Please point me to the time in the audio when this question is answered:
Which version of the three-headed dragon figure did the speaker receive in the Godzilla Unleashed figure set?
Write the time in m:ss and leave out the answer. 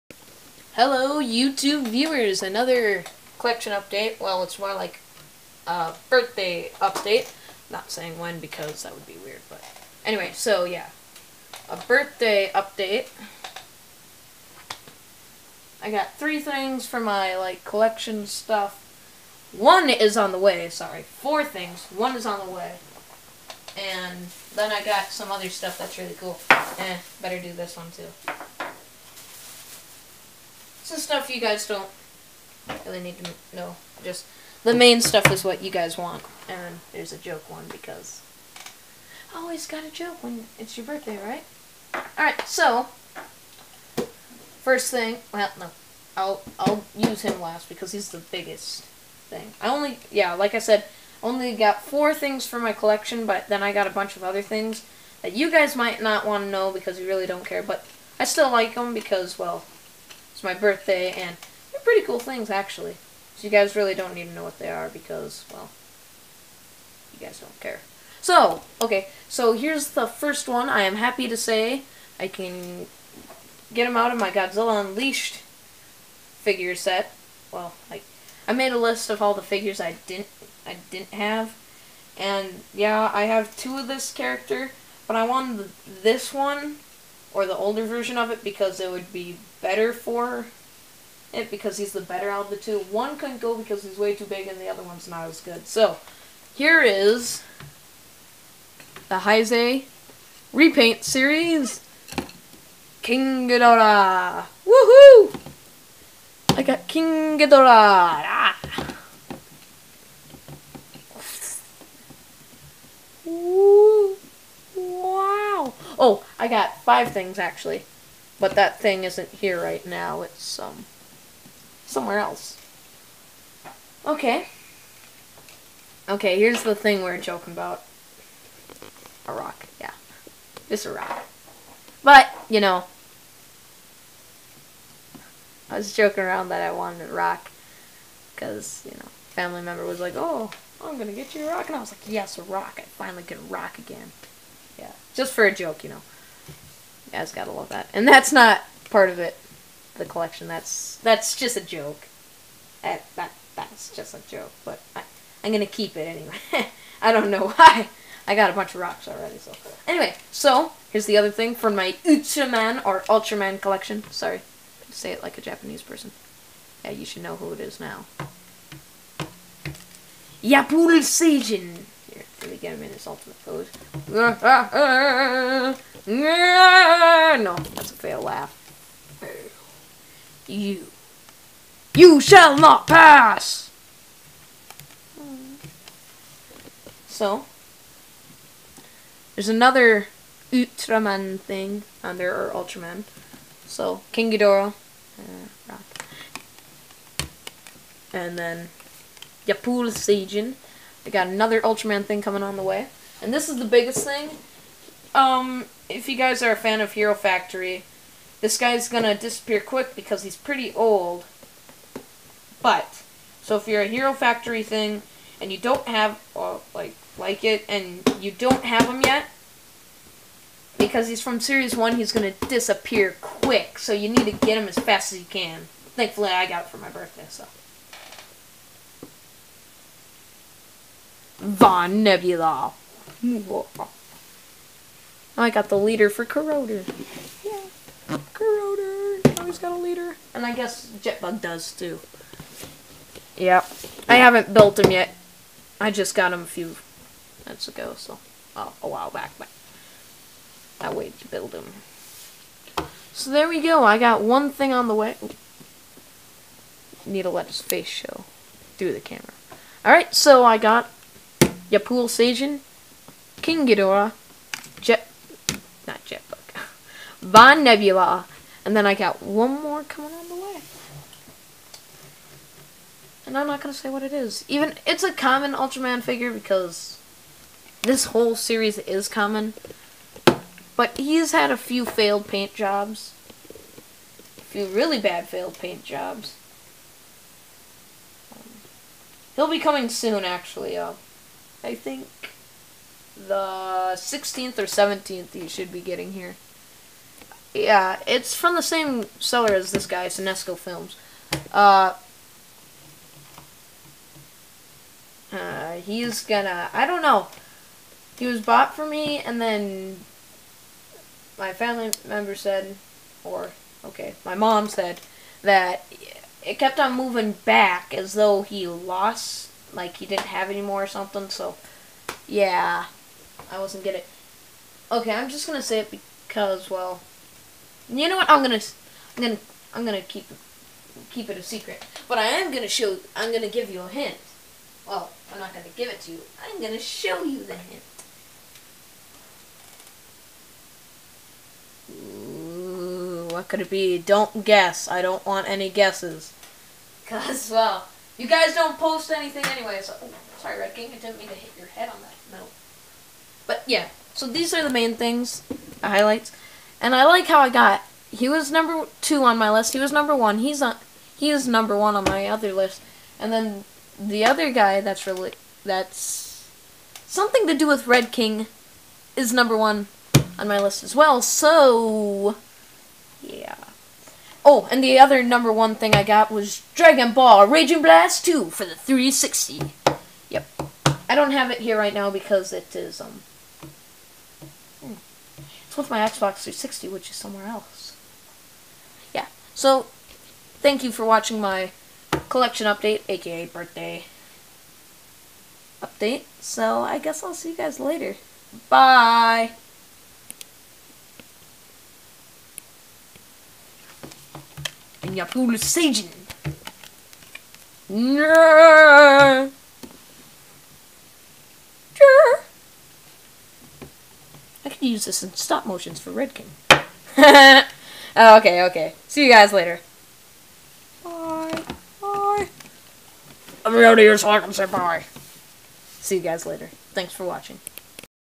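1:39.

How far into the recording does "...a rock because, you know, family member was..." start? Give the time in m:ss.
2:17.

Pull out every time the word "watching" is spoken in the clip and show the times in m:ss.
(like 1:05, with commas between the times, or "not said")
6:31, 7:07.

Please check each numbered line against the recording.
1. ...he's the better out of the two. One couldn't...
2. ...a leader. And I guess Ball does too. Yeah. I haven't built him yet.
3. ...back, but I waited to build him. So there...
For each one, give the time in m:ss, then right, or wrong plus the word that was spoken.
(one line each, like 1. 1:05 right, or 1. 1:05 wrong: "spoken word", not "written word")
1. 1:31 right
2. 3:59 wrong: "Jetbug", not "Ball"
3. 4:09 right.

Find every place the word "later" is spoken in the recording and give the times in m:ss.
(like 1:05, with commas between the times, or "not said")
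6:37, 6:59, 7:06.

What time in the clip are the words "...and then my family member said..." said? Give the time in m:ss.
5:09.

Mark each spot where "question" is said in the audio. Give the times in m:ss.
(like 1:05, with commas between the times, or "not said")
not said.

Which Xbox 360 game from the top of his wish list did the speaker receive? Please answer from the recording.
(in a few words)
Dragon Ball Raging Blast 2.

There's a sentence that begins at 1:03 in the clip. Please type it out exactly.
So you guys really don't need to know what they are because, well, you guys don't care.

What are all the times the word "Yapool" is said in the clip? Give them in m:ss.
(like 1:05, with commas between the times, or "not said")
2:50, 3:19, 4:21.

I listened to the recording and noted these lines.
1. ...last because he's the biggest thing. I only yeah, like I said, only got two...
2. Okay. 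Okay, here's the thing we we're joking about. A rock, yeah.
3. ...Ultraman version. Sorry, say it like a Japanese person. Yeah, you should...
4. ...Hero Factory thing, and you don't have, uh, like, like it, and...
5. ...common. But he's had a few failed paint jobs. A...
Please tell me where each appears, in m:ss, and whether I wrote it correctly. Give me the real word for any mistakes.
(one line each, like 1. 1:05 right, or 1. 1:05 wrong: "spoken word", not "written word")
1. 0:47 wrong: "four", not "two"
2. 2:04 right
3. 2:43 wrong: "collection", not "version"
4. 3:33 right
5. 4:39 right.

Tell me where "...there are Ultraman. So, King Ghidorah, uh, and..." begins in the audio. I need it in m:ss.
3:12.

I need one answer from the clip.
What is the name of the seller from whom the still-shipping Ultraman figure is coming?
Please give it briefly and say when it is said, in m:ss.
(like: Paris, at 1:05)
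Sinesco Films, at 5:00.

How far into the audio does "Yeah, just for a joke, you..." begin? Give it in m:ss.
2:24.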